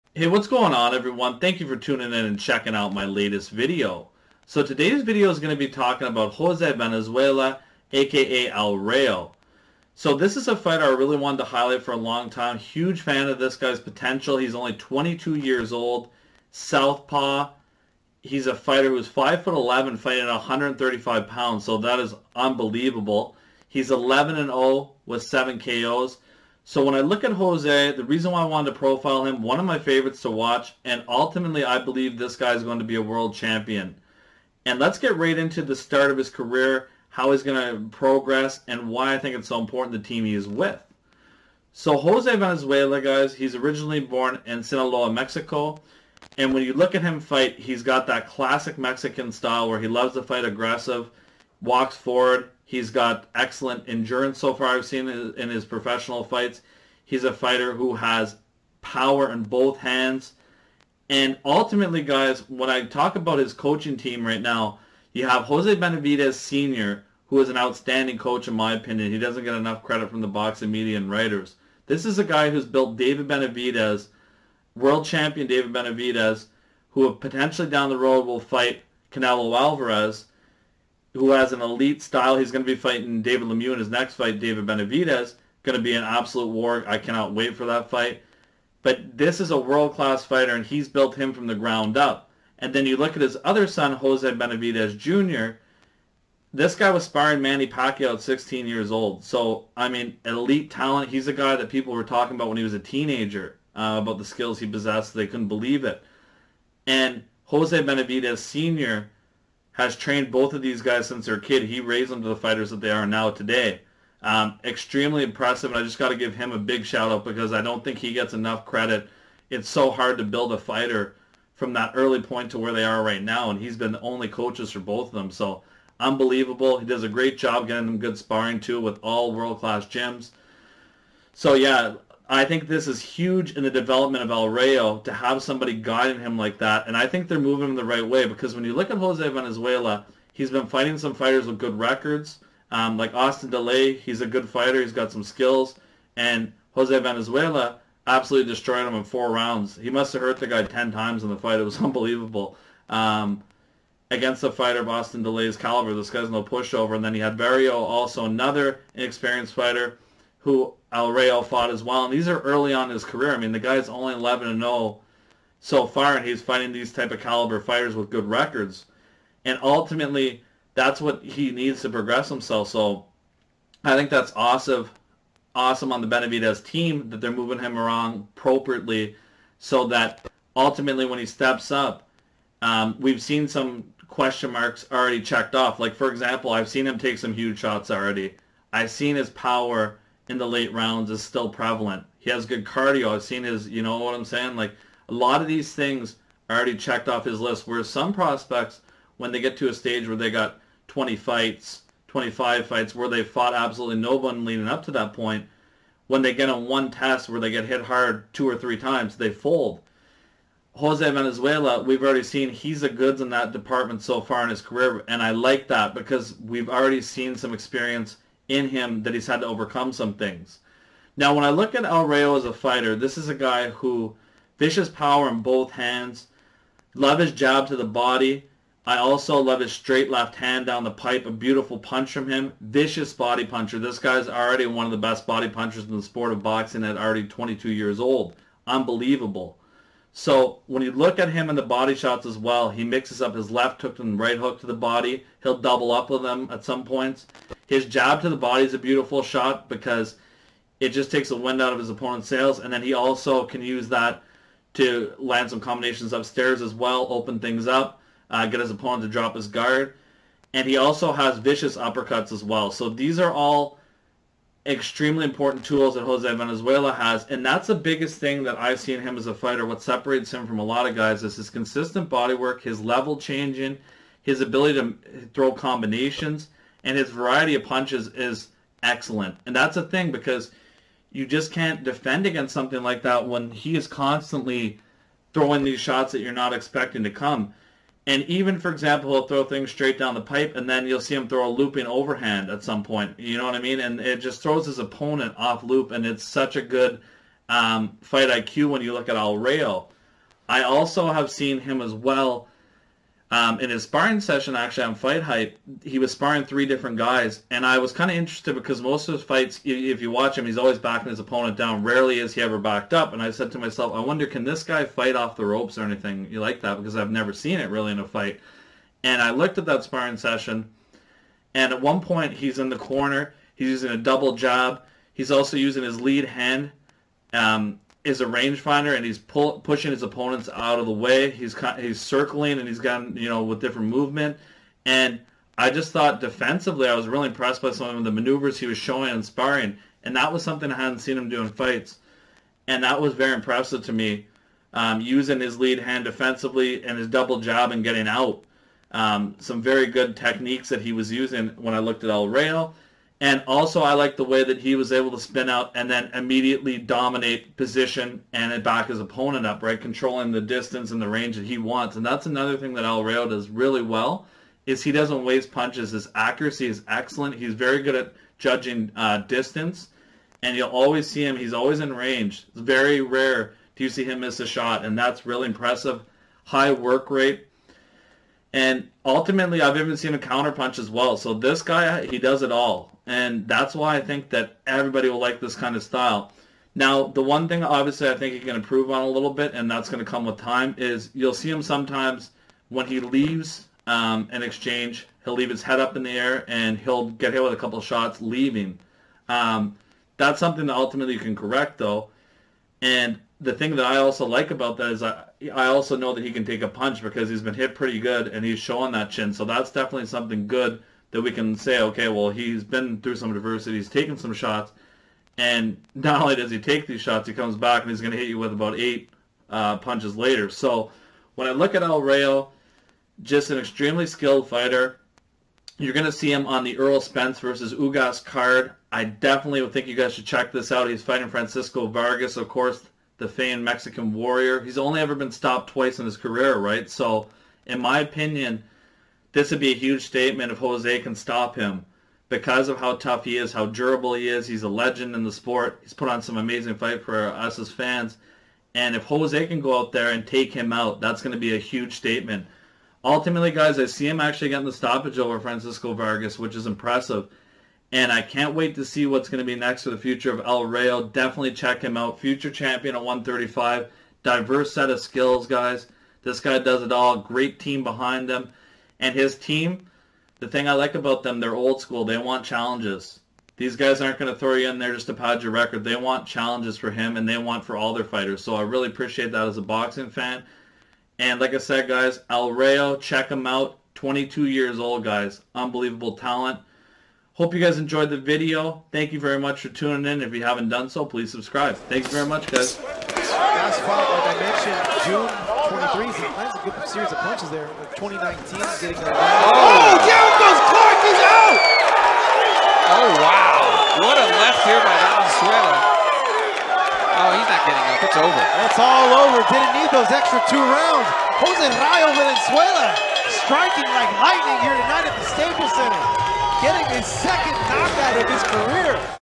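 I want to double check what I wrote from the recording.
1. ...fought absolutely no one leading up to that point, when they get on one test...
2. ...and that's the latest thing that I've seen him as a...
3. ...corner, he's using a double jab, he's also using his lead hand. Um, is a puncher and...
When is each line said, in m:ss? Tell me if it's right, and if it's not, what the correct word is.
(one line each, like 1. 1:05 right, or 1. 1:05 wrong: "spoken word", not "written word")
1. 3:23 right
2. 4:27 wrong: "biggest", not "latest"
3. 5:22 wrong: "rangefinder", not "puncher".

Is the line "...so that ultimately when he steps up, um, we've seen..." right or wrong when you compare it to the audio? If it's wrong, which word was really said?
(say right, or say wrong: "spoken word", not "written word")
right.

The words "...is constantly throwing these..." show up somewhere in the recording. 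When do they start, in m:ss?
4:43.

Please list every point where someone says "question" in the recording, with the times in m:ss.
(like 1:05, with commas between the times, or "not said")
3:04.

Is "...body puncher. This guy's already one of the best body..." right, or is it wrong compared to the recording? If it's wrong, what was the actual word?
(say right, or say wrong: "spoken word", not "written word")
right.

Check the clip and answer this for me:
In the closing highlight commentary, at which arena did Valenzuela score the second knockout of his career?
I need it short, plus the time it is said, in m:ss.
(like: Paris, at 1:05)
Staples Center, at 8:35.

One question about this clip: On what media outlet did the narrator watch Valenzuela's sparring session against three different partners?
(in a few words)
Fight Hype.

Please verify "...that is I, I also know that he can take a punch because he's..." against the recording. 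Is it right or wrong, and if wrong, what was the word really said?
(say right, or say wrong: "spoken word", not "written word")
right.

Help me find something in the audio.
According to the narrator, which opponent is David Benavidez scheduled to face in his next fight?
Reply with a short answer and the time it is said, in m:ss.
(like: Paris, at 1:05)
David Lemieux, at 1:23.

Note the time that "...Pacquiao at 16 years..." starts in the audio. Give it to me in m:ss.
1:37.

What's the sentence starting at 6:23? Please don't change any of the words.
And that's why I think that everybody will like this kind of style.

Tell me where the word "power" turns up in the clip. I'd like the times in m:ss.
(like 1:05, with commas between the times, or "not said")
0:58, 3:09, 3:44.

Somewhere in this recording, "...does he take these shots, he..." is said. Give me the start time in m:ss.
6:56.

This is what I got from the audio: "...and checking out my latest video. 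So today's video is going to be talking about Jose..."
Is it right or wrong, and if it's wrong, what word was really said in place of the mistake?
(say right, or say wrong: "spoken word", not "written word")
right.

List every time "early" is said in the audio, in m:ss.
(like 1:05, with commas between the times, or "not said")
2:01, 2:42.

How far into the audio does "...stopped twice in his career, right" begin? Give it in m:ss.
7:15.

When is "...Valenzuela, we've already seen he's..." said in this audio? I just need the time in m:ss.
3:31.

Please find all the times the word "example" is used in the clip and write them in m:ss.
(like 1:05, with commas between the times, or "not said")
3:06, 4:48.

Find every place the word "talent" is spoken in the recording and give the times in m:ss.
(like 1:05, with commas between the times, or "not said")
1:40, 8:06.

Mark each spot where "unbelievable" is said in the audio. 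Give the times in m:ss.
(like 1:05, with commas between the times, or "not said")
0:22, 2:05, 2:31, 3:58, 8:05.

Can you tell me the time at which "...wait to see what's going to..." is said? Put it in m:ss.
7:38.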